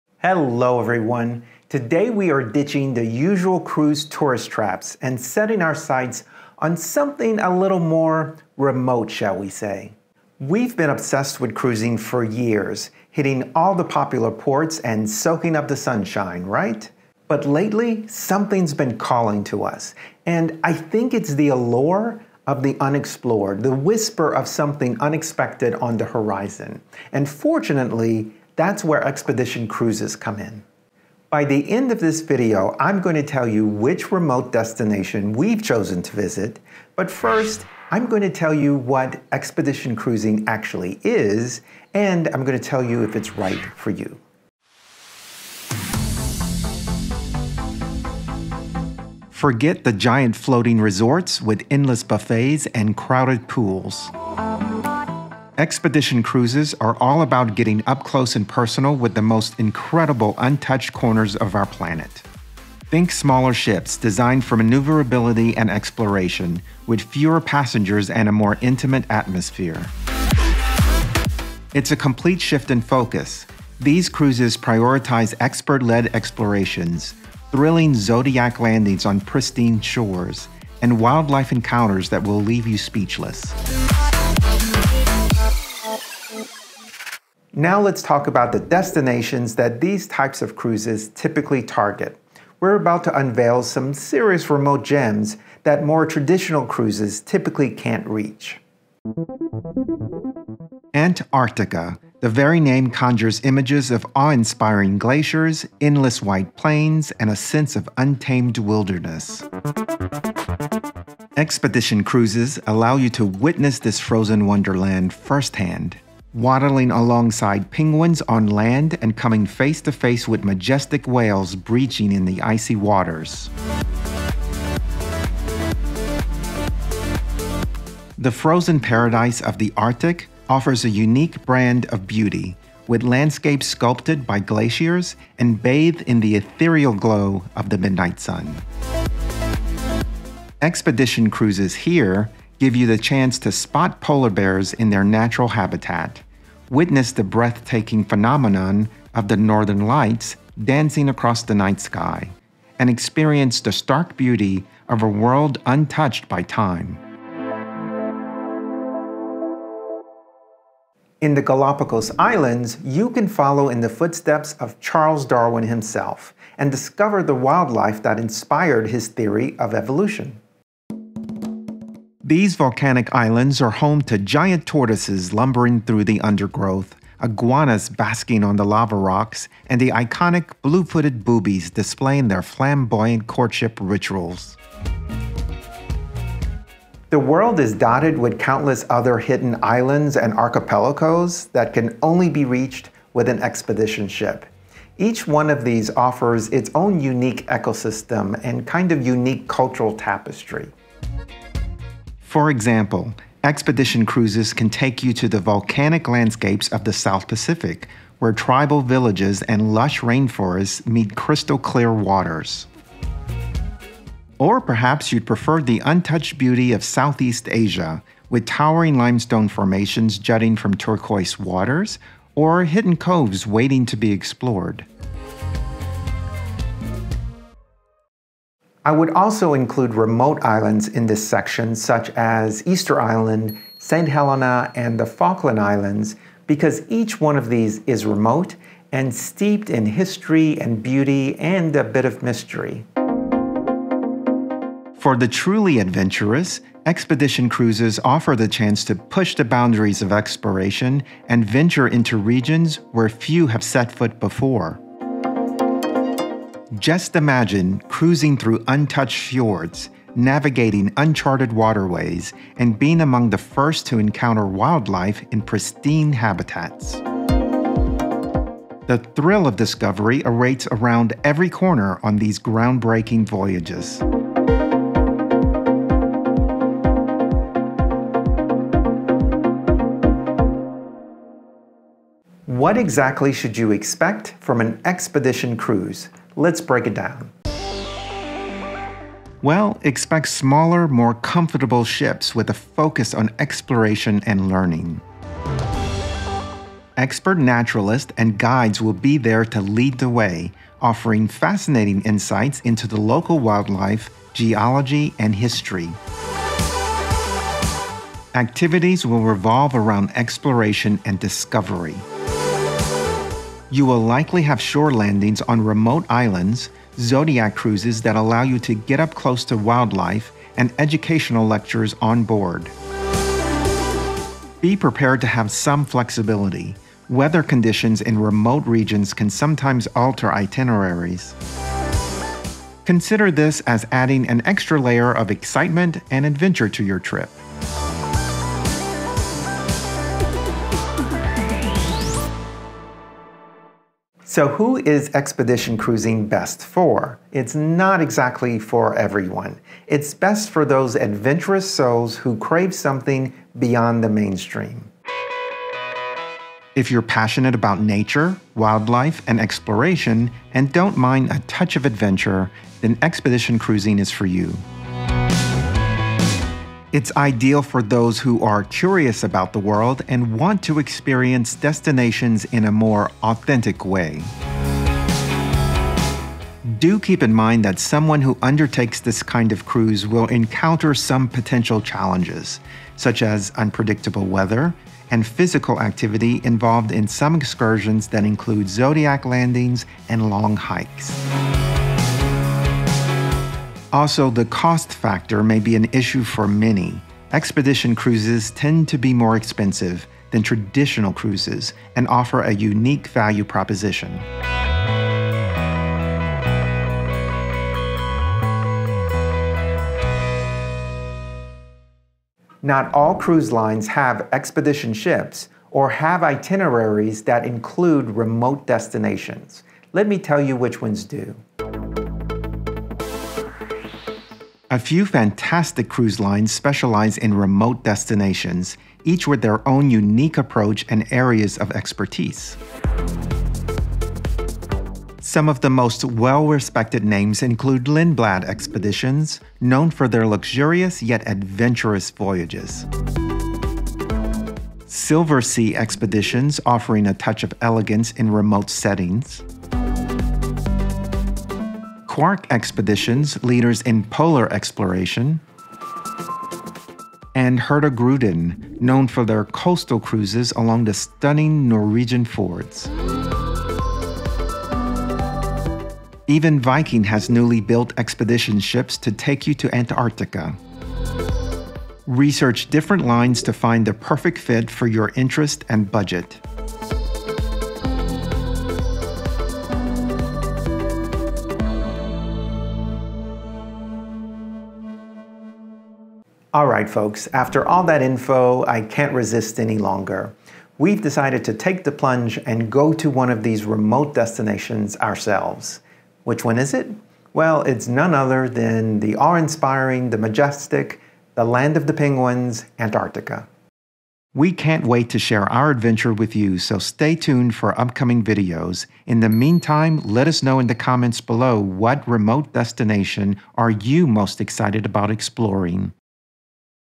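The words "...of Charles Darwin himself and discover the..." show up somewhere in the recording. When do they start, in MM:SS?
02:44.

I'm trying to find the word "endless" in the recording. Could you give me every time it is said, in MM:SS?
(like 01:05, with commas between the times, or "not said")
00:51, 01:45.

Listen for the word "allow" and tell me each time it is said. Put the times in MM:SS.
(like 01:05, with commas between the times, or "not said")
01:52, 05:18.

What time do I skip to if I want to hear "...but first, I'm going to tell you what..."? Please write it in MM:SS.
00:36.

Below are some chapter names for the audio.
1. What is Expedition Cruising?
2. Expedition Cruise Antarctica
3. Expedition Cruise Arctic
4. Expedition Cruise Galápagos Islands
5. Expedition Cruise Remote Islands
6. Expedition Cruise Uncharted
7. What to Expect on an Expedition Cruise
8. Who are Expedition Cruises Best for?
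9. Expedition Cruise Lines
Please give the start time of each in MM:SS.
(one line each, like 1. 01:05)
1. 00:45
2. 01:27
3. 02:08
4. 02:41
5. 03:07
6. 04:04
7. 04:42
8. 05:44
9. 06:52.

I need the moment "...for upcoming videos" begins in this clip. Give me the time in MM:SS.
08:27.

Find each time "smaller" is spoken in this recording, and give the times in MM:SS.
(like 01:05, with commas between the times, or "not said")
01:03, 04:50.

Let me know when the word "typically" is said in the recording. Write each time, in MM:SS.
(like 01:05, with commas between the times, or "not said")
01:31, 01:37.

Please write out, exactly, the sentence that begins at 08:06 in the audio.
All right, folks, after all that info, I can't resist any longer.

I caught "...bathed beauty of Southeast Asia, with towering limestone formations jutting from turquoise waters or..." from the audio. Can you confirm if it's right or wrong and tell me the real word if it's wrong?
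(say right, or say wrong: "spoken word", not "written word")
wrong: "untouched", not "bathed".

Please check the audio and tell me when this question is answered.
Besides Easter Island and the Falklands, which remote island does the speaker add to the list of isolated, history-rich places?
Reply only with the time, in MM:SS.
03:53.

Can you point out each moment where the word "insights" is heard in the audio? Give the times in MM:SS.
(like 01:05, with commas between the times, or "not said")
05:02.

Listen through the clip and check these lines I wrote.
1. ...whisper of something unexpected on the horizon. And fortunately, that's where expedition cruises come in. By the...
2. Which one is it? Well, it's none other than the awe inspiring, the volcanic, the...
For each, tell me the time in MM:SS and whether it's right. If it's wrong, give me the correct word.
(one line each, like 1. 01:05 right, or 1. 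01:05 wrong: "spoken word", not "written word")
1. 00:23 right
2. 08:16 wrong: "majestic", not "volcanic".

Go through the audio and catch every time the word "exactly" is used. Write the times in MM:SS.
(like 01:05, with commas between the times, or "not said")
04:42, 05:47.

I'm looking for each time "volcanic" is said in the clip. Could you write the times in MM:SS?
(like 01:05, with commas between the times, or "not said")
02:52, 03:25.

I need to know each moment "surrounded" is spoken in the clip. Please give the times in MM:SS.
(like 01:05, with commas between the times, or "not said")
not said.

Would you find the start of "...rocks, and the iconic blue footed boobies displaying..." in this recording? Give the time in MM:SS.
02:58.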